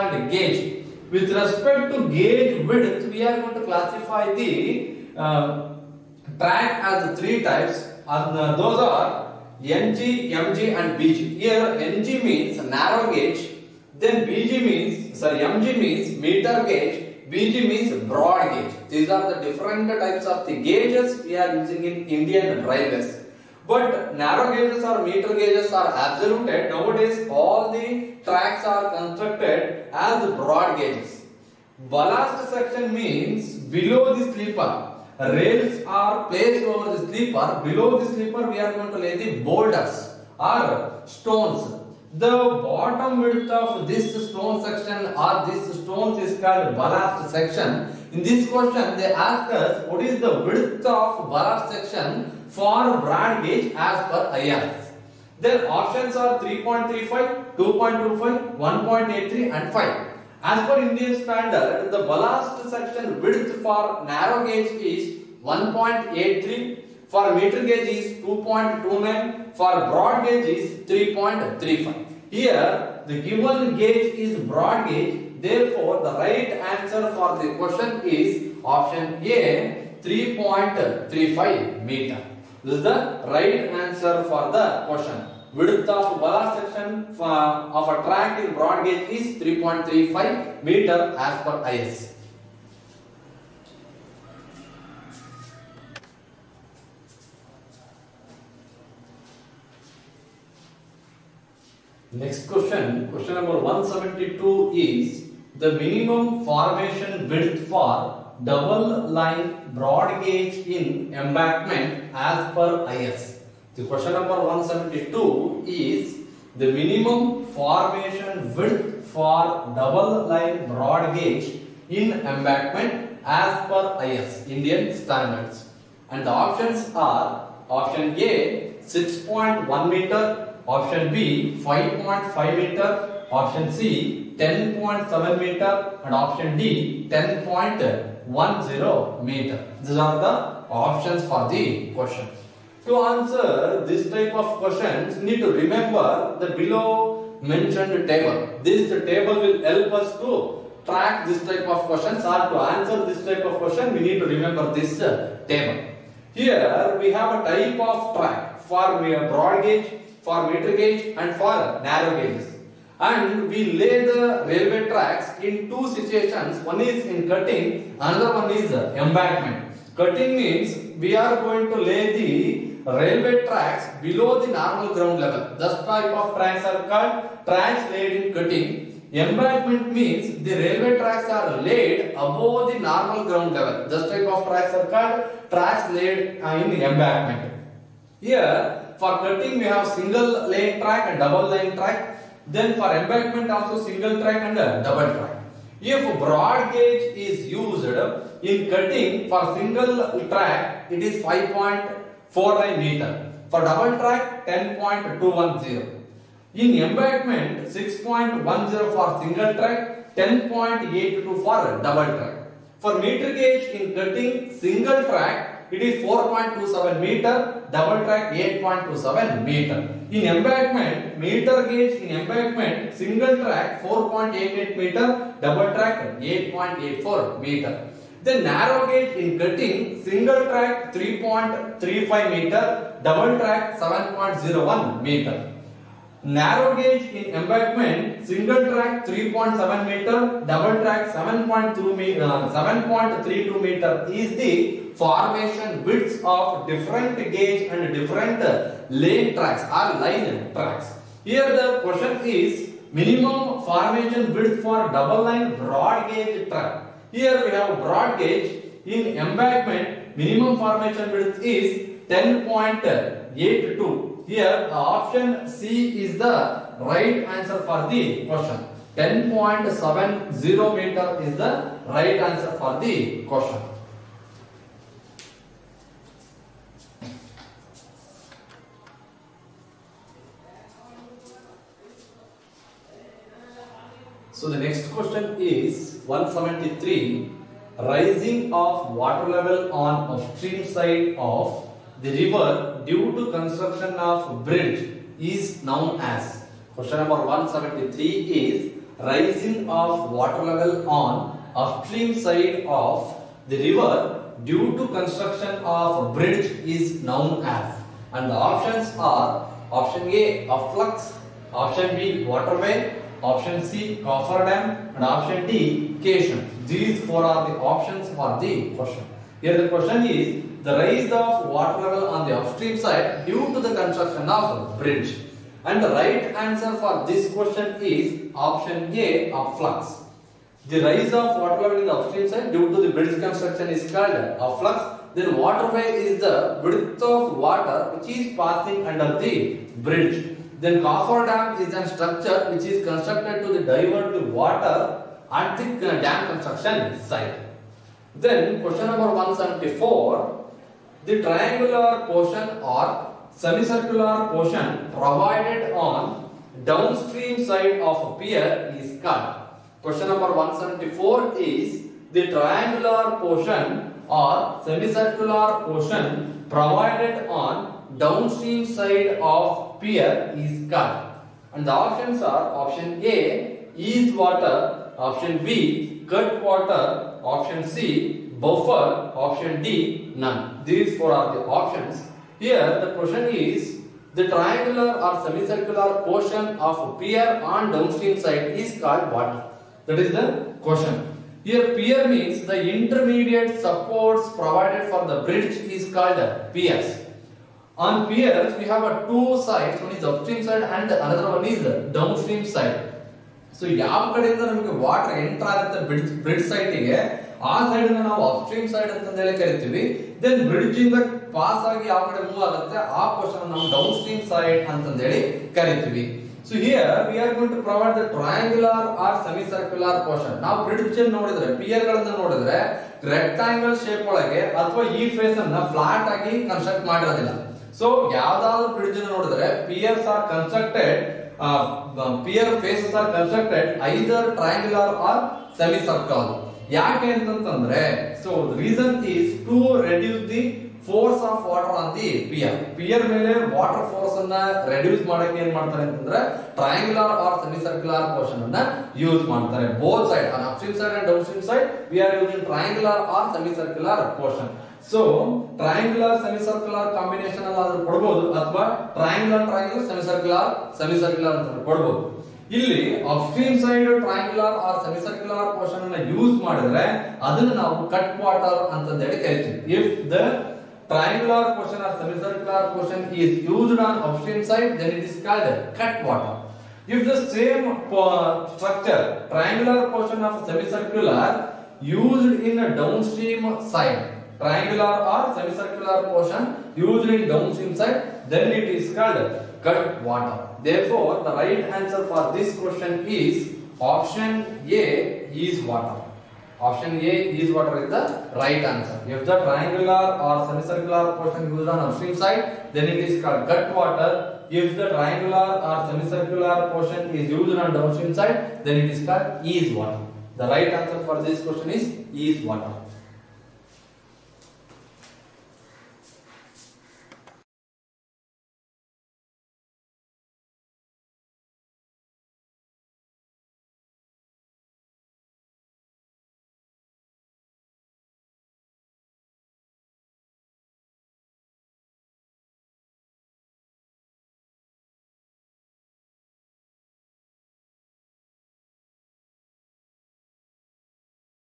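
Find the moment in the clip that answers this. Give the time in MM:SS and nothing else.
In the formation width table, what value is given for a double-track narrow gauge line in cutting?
03:53.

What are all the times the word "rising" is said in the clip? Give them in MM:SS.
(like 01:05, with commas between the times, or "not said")
04:47, 04:59.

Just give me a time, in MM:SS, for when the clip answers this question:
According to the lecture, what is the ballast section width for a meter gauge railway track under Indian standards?
01:08.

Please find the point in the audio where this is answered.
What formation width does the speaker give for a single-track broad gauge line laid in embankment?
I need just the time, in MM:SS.
03:27.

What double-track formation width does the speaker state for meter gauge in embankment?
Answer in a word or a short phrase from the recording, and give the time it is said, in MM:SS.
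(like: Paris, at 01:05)
8.84 meters, at 03:46.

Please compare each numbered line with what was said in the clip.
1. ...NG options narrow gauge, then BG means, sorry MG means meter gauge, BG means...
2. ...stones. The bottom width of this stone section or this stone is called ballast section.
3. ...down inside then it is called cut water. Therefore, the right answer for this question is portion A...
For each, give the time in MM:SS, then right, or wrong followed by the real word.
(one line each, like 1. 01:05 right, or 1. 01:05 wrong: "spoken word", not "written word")
1. 00:11 wrong: "means", not "options"
2. 00:41 right
3. 08:07 wrong: "option", not "portion".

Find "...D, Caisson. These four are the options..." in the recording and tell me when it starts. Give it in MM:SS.
05:15.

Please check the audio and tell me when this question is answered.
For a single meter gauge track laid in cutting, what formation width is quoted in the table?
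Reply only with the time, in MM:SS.
03:36.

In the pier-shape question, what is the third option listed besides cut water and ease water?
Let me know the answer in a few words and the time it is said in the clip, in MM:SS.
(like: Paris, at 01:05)
Buffer, at 06:18.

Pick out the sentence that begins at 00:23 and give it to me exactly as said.
But narrow gauges or meter gauges are absolute.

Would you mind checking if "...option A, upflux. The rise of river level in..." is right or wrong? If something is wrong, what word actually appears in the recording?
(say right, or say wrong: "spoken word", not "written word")
wrong: "water", not "river".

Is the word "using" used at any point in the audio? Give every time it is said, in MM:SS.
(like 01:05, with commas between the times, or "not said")
00:21.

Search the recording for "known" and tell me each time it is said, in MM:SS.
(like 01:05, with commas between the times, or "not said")
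04:55, 05:07.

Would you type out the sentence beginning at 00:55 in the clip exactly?
Their options are 3.35, 2.25, 1.83 and 5.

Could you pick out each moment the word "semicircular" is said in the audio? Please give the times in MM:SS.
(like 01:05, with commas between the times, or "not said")
05:53, 06:04, 06:25, 08:00, 08:05, 08:20, 08:25.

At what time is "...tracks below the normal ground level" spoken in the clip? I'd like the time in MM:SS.
02:53.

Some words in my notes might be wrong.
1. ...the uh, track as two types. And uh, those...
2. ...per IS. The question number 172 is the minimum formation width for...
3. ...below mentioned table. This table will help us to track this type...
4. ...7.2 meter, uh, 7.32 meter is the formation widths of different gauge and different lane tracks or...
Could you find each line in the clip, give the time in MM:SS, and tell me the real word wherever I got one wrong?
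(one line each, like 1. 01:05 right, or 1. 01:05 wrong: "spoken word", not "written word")
1. 00:04 wrong: "three", not "two"
2. 01:52 right
3. 02:26 right
4. 04:01 right.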